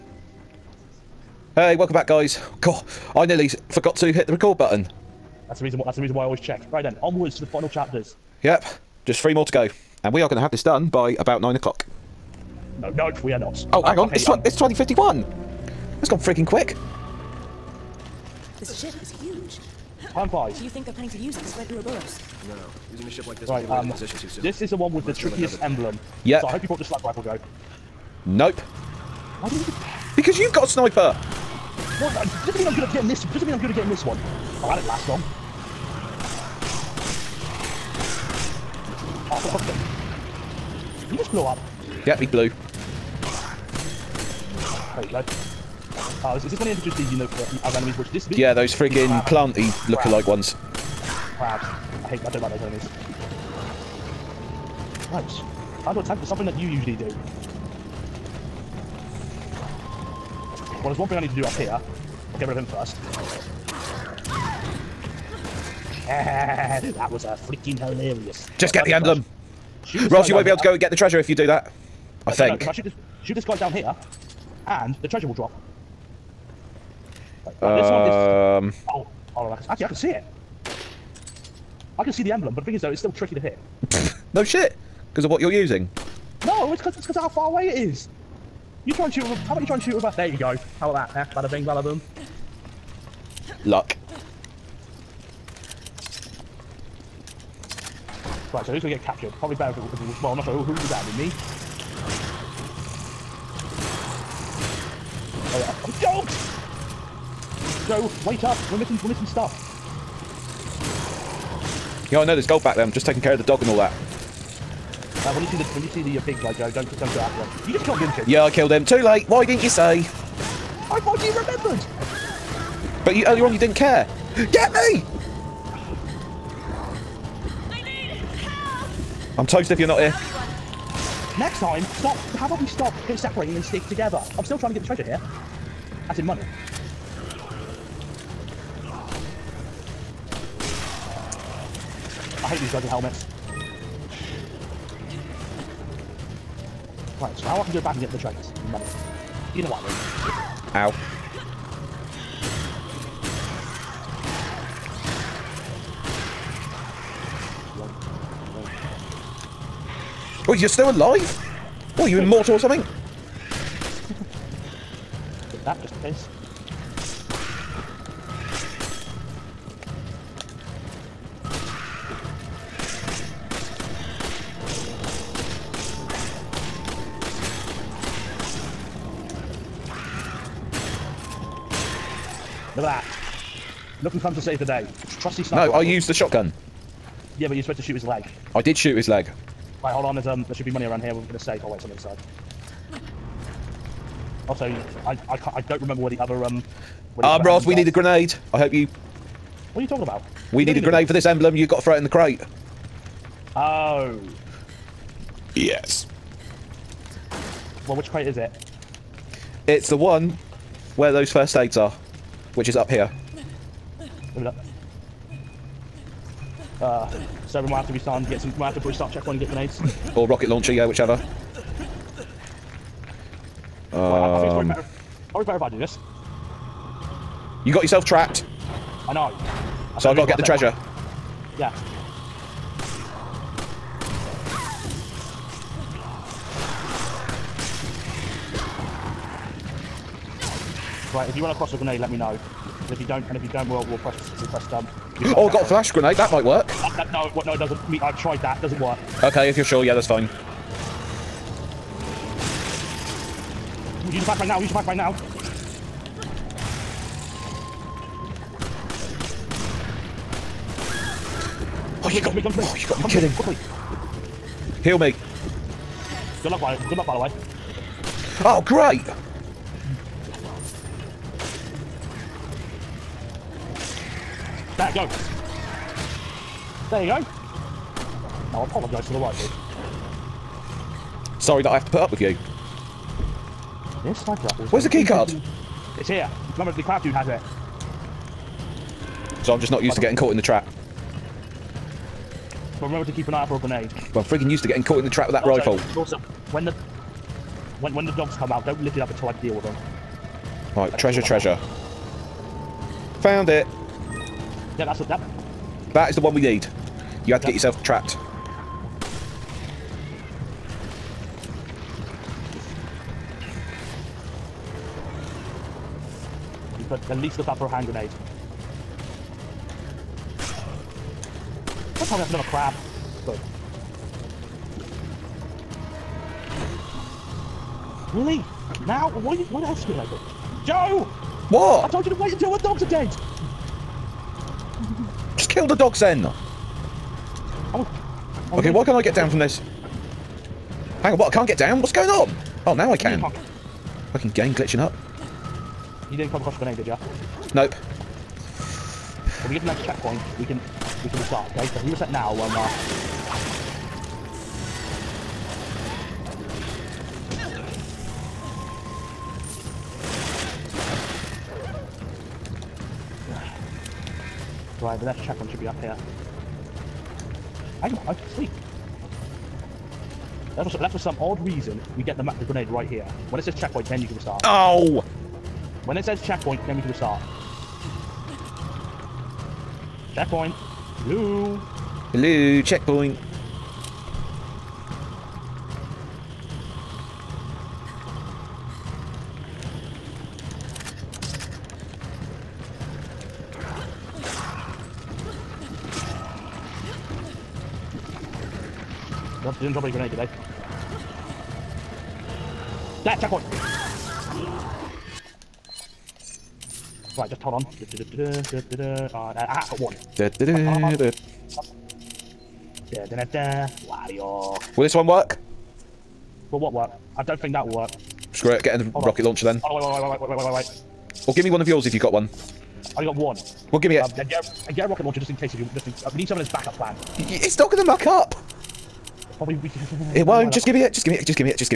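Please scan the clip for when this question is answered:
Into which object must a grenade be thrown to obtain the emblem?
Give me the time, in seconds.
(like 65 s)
202 s.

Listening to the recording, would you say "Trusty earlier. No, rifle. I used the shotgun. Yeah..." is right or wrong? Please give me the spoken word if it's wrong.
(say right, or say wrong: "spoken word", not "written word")
wrong: "sniper", not "earlier".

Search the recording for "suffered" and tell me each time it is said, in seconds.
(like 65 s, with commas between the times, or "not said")
not said.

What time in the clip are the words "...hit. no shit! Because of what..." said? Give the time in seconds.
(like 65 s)
83 s.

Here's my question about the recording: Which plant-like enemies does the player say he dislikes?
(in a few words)
Crabs.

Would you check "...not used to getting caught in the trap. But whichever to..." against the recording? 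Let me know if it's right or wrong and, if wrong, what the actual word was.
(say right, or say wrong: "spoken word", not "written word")
wrong: "remember", not "whichever".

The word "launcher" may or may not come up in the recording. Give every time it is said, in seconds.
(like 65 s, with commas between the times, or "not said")
220 s, 419 s, 425 s.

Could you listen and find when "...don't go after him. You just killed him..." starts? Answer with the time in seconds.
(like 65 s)
117 s.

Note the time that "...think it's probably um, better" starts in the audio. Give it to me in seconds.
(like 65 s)
224 s.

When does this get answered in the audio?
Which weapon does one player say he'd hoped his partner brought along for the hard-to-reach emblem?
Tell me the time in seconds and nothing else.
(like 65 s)
26 s.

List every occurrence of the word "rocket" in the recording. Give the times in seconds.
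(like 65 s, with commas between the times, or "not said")
220 s, 419 s, 424 s.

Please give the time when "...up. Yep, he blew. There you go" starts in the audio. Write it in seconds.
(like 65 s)
41 s.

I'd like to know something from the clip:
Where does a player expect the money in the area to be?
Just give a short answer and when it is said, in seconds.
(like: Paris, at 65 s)
in a safe, at 191 s.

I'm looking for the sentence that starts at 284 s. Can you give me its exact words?
This side Where's the key card?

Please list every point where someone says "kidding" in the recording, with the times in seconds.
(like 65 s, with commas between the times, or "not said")
263 s.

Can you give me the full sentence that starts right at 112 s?
I'm just taking care of the dog and all that.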